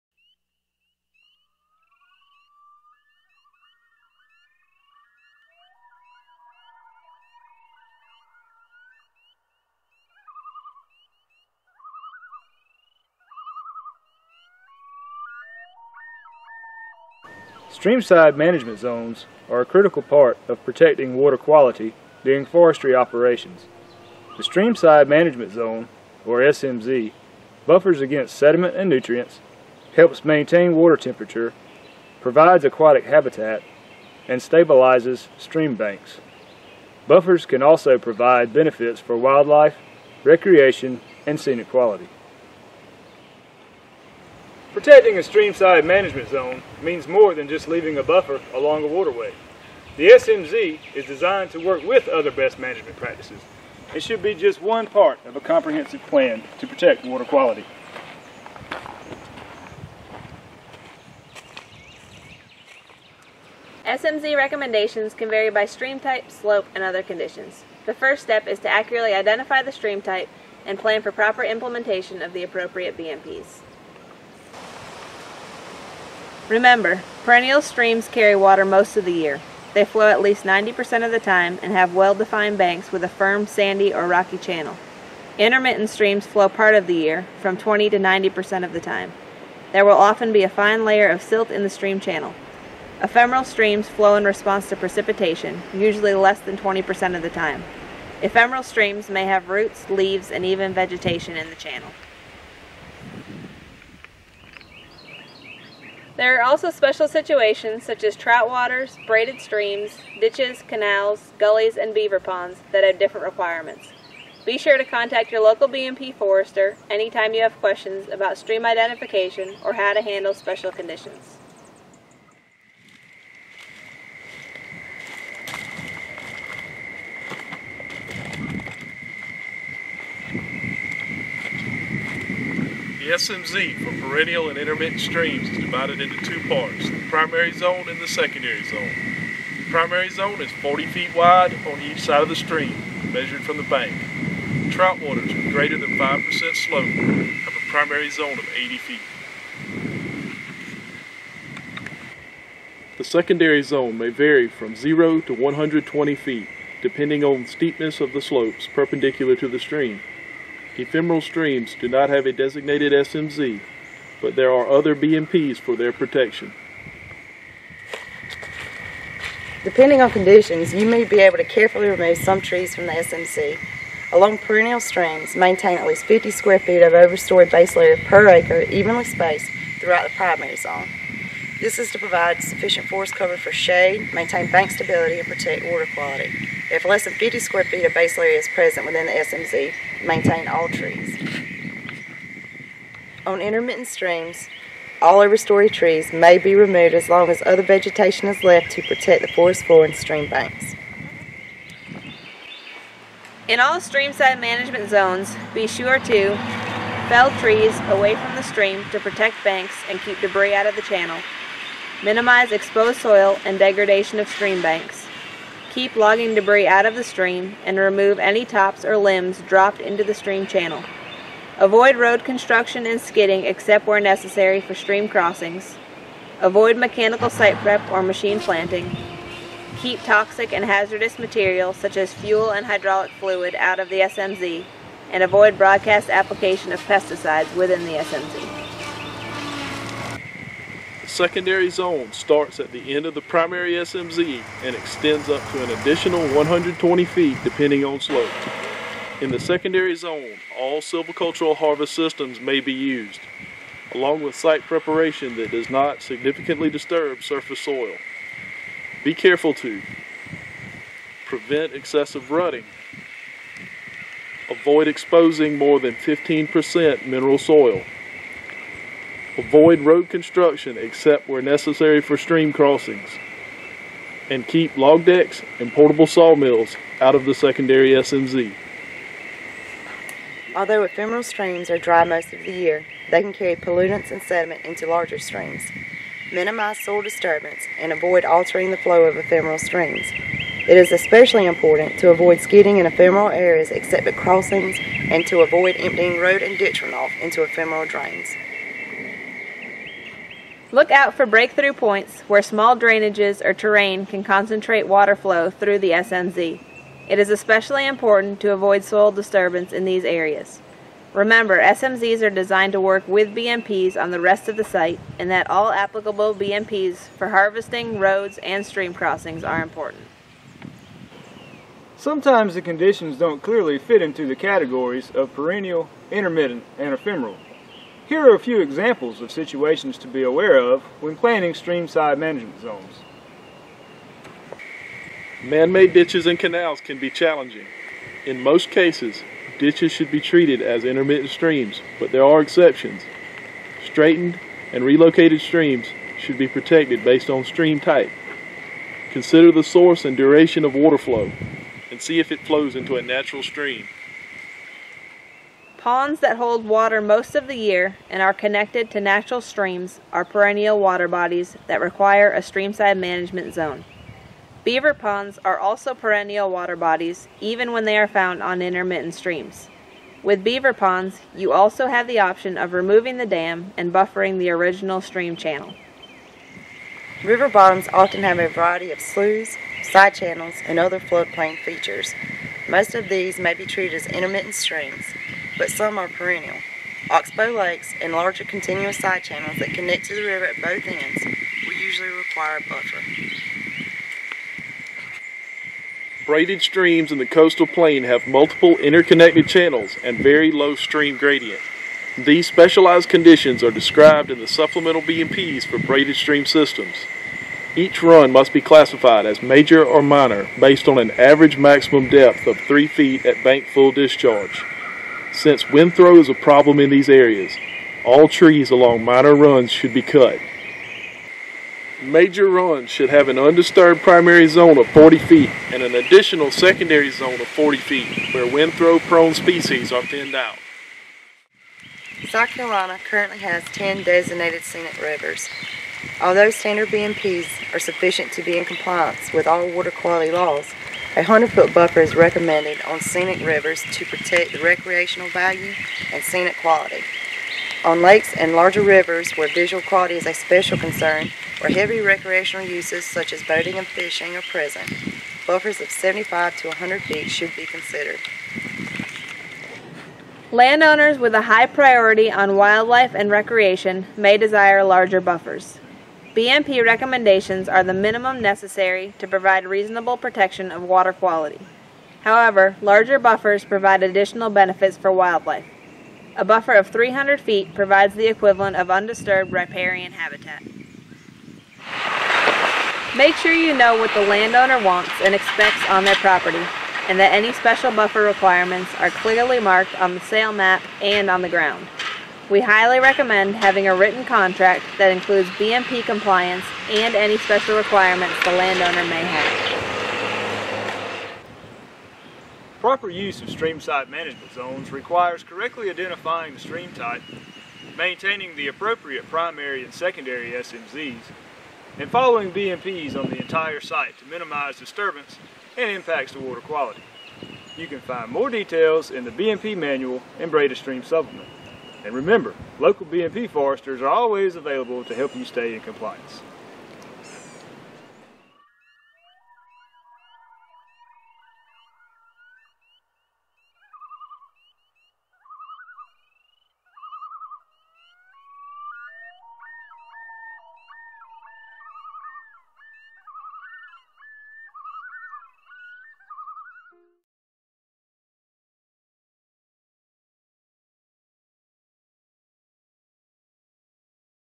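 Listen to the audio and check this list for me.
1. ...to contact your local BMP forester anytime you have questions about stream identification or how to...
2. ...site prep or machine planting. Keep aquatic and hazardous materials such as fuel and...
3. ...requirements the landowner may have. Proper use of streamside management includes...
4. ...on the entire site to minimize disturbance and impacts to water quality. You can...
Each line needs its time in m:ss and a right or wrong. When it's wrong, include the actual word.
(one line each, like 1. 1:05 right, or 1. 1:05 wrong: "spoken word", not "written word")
1. 1:54 right
2. 3:47 wrong: "toxic", not "aquatic"
3. 8:17 wrong: "zones", not "includes"
4. 8:33 right.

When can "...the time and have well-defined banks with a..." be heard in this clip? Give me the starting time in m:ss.
1:21.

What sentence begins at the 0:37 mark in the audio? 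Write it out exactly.
Buffers can also provide benefits for wildlife, recreation, and scenic quality.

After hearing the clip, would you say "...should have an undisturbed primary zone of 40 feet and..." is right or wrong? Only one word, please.
right.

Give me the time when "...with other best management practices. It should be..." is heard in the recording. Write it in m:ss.
0:51.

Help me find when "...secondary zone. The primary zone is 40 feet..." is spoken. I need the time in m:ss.
2:18.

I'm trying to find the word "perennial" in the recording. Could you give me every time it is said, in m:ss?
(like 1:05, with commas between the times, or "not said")
1:17, 2:14, 2:54, 5:25, 6:00, 6:05, 6:26.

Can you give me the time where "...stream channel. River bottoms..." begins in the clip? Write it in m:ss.
6:15.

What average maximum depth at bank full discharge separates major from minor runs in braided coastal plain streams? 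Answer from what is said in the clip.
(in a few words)
3 feet.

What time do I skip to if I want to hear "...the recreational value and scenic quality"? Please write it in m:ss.
7:24.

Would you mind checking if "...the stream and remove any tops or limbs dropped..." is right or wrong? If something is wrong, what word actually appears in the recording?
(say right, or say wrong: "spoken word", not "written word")
right.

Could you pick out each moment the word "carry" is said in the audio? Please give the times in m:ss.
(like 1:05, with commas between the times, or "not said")
1:18, 4:43.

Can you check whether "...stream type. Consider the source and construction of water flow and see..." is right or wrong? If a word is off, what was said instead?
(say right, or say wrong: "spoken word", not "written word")
wrong: "duration", not "construction".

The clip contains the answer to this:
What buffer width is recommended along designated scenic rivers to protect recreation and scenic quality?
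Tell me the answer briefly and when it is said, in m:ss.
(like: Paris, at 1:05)
100 feet, at 7:21.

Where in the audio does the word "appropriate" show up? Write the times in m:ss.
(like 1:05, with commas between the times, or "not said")
1:12, 8:28.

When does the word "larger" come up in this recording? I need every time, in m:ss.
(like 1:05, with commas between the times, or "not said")
4:44, 6:28, 7:28, 7:44, 7:52.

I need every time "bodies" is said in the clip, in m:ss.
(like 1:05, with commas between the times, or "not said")
6:01, 6:06.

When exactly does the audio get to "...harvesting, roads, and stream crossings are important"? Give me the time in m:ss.
5:17.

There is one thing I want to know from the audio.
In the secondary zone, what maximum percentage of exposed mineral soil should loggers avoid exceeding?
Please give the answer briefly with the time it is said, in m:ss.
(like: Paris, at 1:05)
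15%, at 4:25.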